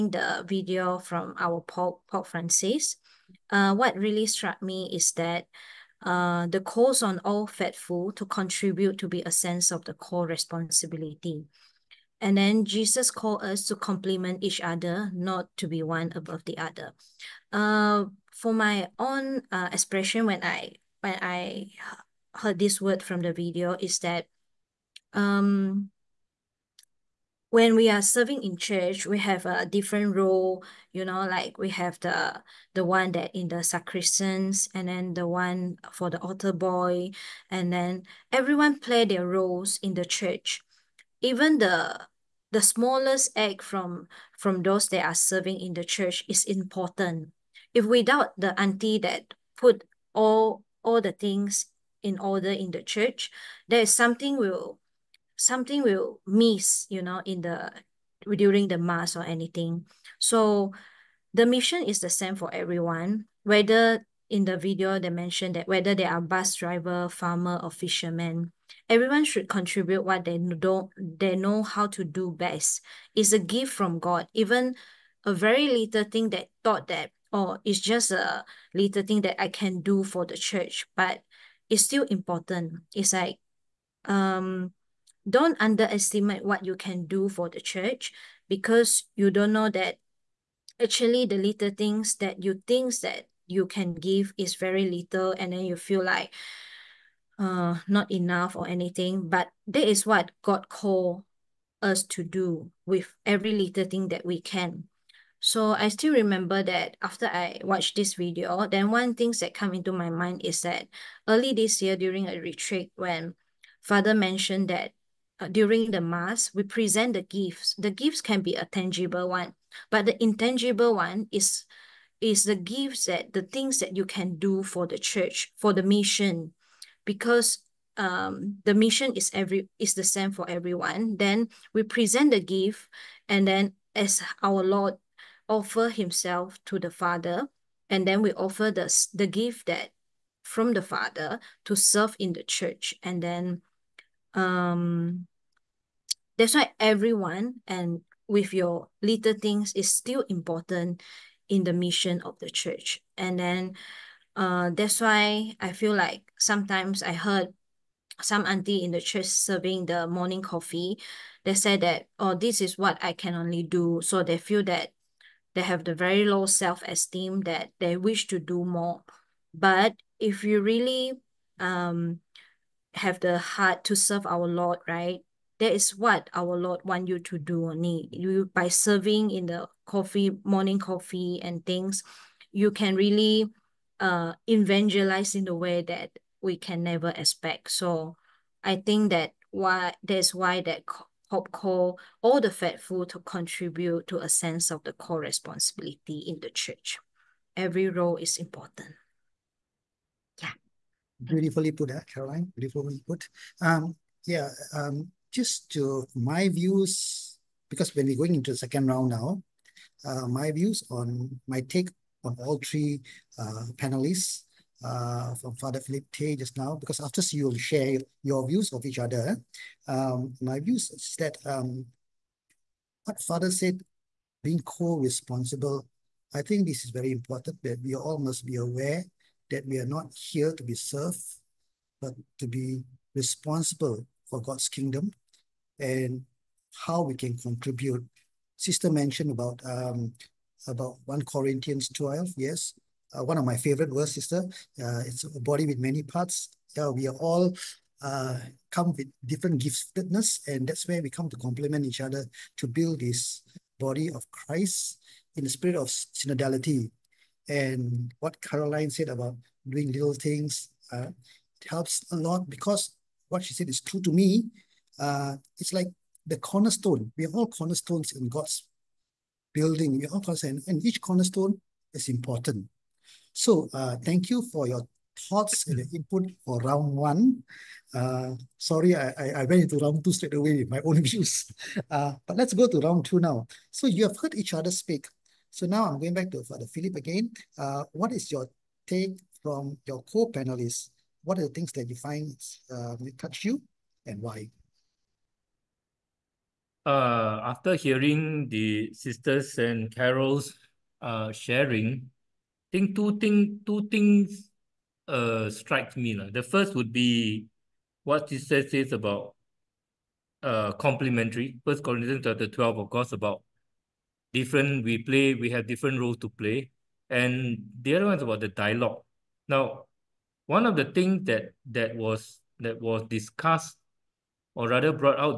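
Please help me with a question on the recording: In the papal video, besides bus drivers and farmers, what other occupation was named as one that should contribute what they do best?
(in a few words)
fisherman.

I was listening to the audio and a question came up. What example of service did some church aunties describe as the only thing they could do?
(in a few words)
serving the morning coffee.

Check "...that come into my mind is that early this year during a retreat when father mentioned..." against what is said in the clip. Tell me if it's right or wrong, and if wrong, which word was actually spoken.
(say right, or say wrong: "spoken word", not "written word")
right.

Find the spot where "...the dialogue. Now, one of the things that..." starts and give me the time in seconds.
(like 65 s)
318 s.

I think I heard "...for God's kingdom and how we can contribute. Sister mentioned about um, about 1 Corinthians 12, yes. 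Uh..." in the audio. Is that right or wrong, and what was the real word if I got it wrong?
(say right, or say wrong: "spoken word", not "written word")
right.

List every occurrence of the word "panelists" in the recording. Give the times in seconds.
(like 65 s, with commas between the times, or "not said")
213 s, 290 s.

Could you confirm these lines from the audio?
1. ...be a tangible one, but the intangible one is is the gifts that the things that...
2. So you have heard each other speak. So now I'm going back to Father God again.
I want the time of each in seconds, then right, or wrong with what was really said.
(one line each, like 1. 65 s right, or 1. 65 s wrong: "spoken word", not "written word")
1. 118 s right
2. 283 s wrong: "Philip", not "God".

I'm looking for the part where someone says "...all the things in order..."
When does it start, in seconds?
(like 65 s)
50 s.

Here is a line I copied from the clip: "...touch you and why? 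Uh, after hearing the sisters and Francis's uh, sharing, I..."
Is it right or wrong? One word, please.
wrong.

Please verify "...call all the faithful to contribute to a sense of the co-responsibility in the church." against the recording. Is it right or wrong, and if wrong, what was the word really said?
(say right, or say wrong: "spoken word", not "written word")
right.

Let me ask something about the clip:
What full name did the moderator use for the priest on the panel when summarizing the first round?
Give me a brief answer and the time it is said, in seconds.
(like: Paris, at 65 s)
Father Philip Tay, at 215 s.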